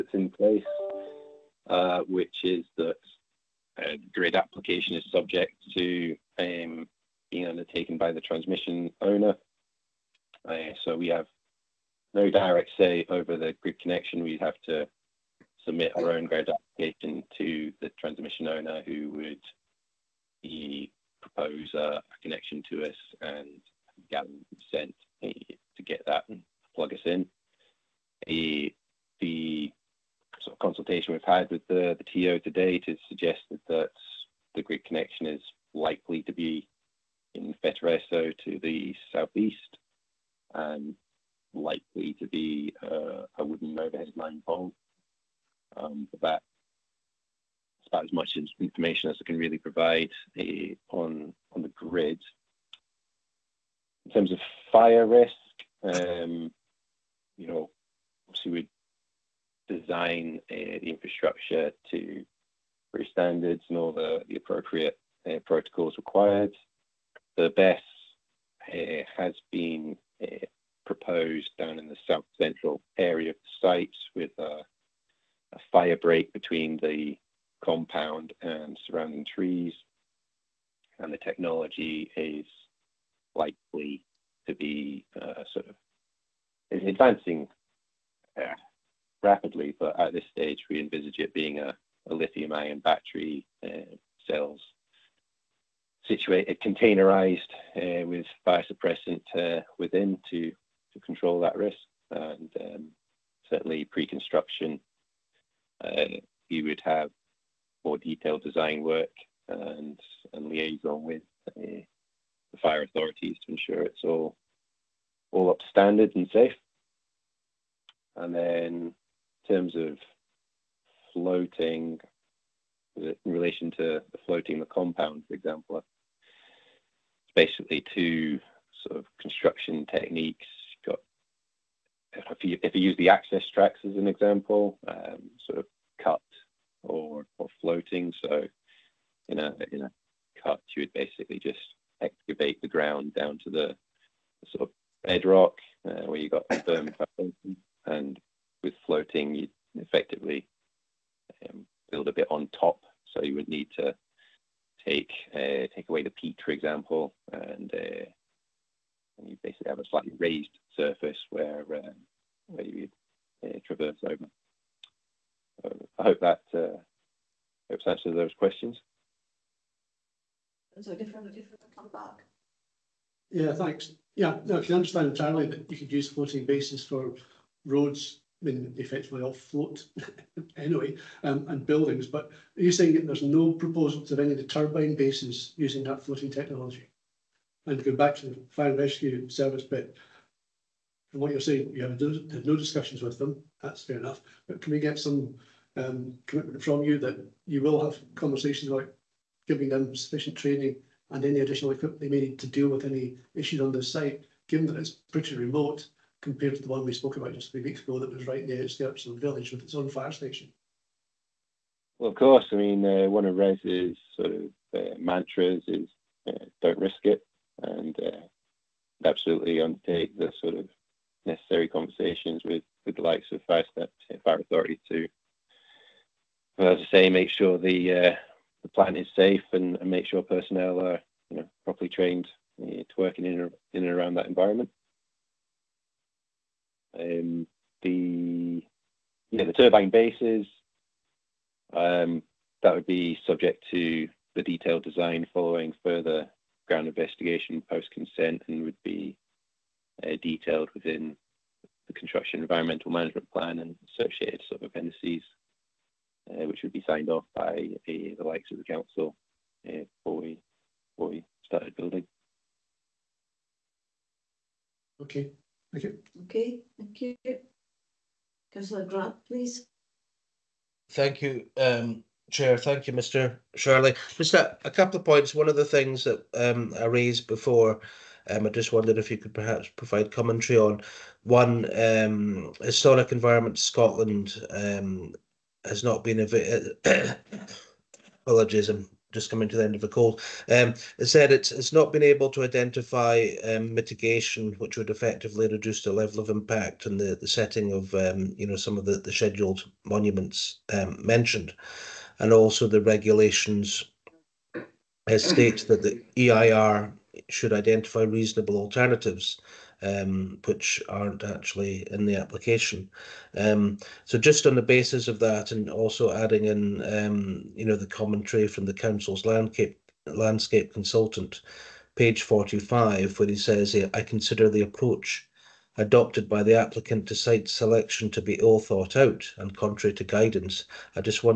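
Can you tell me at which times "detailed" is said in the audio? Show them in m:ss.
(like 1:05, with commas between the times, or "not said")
1:47, 4:04, 4:10.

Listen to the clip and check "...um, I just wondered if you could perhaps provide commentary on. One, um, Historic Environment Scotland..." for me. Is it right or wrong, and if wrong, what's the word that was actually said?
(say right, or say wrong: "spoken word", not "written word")
right.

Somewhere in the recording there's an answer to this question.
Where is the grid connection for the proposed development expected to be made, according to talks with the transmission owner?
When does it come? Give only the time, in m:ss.
0:37.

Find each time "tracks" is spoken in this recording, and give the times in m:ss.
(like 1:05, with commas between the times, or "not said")
2:13.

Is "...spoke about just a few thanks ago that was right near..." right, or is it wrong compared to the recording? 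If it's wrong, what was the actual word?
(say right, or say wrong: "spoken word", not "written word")
wrong: "weeks", not "thanks".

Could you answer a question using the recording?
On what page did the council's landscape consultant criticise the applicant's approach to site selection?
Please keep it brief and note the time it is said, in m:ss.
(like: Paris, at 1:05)
45, at 5:22.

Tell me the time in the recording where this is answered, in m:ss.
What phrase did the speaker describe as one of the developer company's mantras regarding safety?
3:36.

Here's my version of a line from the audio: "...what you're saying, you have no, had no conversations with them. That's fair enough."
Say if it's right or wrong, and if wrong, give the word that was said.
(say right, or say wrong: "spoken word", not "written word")
wrong: "discussions", not "conversations".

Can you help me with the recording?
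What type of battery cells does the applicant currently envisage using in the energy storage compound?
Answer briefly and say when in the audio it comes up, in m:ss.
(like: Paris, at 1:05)
lithium-ion, at 1:32.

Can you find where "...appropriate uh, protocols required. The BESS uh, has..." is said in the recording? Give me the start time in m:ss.
1:04.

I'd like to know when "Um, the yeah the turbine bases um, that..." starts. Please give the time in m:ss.
3:56.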